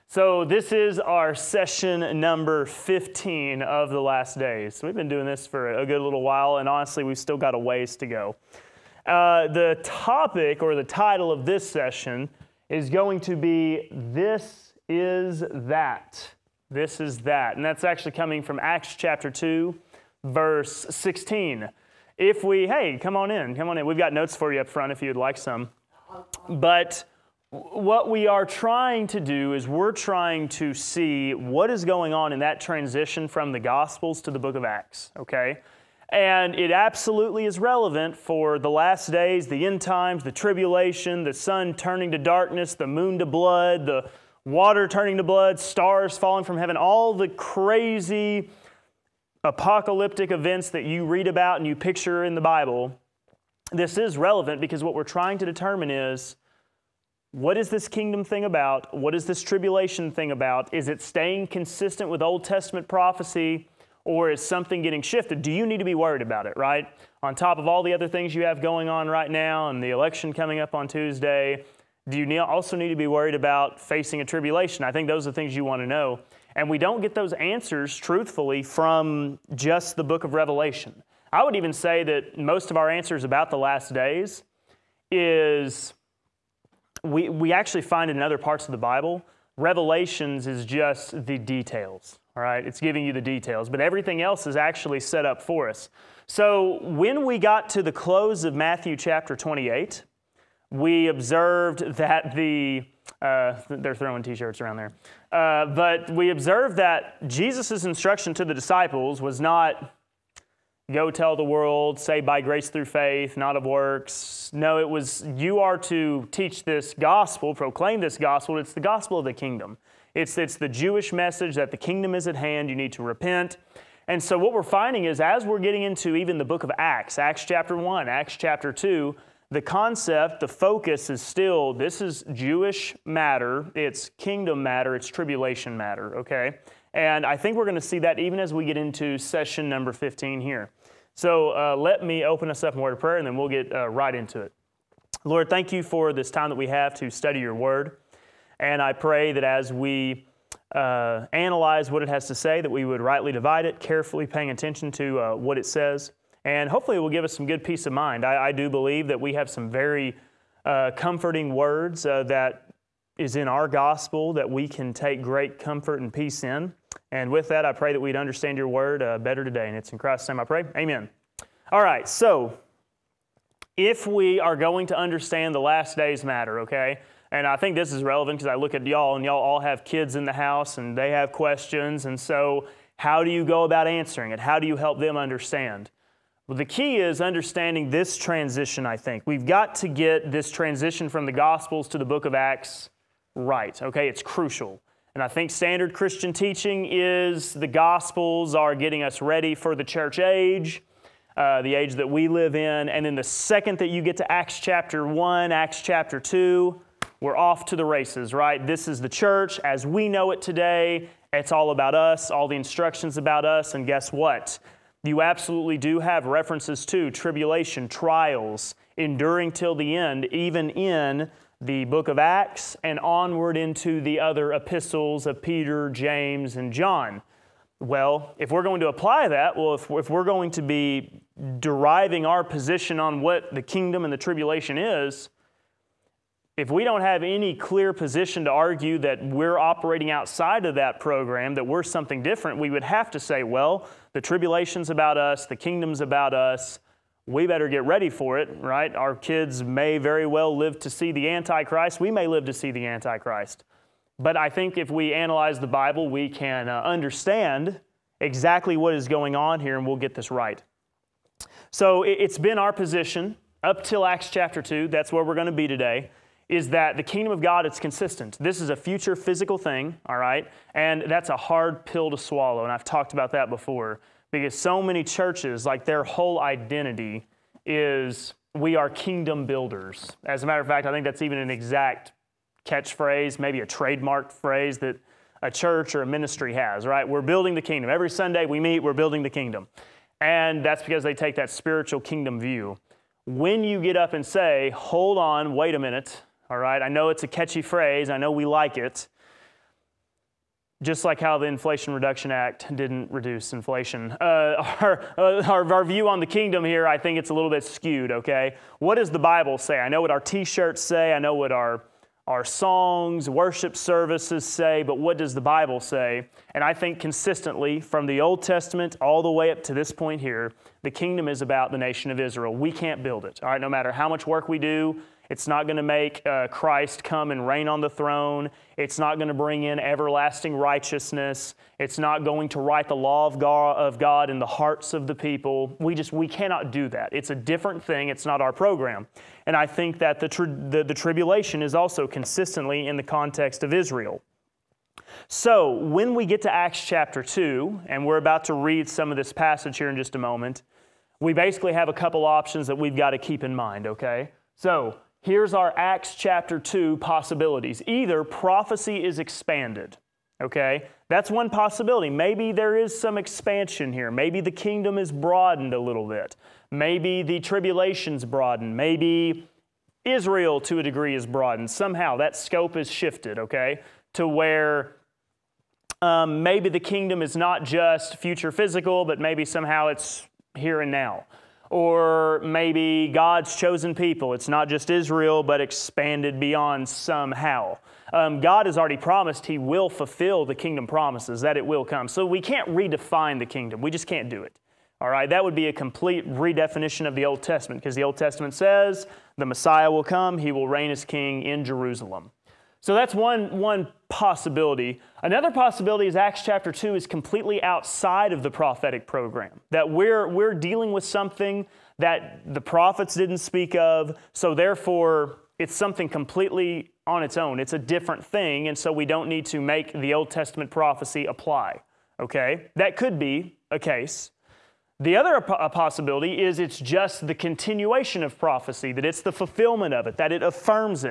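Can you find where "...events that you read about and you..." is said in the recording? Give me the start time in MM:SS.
00:50.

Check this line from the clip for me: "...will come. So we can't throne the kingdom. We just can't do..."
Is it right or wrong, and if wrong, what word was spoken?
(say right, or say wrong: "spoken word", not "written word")
wrong: "redefine", not "throne".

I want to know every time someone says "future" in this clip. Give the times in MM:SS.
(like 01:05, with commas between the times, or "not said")
04:28, 06:18.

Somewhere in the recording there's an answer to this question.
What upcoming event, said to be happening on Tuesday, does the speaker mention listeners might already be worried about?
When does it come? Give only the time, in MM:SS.
01:09.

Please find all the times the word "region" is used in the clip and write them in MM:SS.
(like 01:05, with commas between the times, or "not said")
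not said.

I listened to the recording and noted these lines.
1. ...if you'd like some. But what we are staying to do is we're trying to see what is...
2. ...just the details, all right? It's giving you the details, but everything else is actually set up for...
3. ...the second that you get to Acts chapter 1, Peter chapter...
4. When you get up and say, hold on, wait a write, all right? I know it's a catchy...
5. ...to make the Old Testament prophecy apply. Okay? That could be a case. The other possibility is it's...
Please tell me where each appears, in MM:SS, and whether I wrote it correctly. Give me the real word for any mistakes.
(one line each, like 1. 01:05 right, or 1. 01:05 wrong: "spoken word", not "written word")
1. 00:24 wrong: "trying", not "staying"
2. 01:30 right
3. 03:23 wrong: "Acts", not "Peter"
4. 04:53 wrong: "minute", not "write"
5. 06:59 right.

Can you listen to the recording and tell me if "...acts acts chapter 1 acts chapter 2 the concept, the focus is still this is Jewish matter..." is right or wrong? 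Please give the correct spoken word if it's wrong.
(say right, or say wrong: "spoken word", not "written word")
right.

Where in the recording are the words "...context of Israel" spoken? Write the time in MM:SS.
05:43.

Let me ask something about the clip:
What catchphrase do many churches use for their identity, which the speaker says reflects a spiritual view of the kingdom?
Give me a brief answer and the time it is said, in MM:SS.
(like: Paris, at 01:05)
Kingdom builders, at 04:38.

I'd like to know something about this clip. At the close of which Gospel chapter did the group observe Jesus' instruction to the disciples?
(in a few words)
Matthew 28.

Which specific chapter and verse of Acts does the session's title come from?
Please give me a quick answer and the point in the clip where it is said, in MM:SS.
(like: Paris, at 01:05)
Acts 2:16, at 00:18.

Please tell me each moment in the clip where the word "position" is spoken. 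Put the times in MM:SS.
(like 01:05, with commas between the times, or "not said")
03:52, 03:57, 04:22.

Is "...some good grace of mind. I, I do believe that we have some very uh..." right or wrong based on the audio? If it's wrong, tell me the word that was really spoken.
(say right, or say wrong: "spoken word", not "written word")
wrong: "peace", not "grace".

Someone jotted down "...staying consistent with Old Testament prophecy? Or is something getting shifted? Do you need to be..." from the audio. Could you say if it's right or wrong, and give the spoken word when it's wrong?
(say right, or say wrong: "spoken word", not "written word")
right.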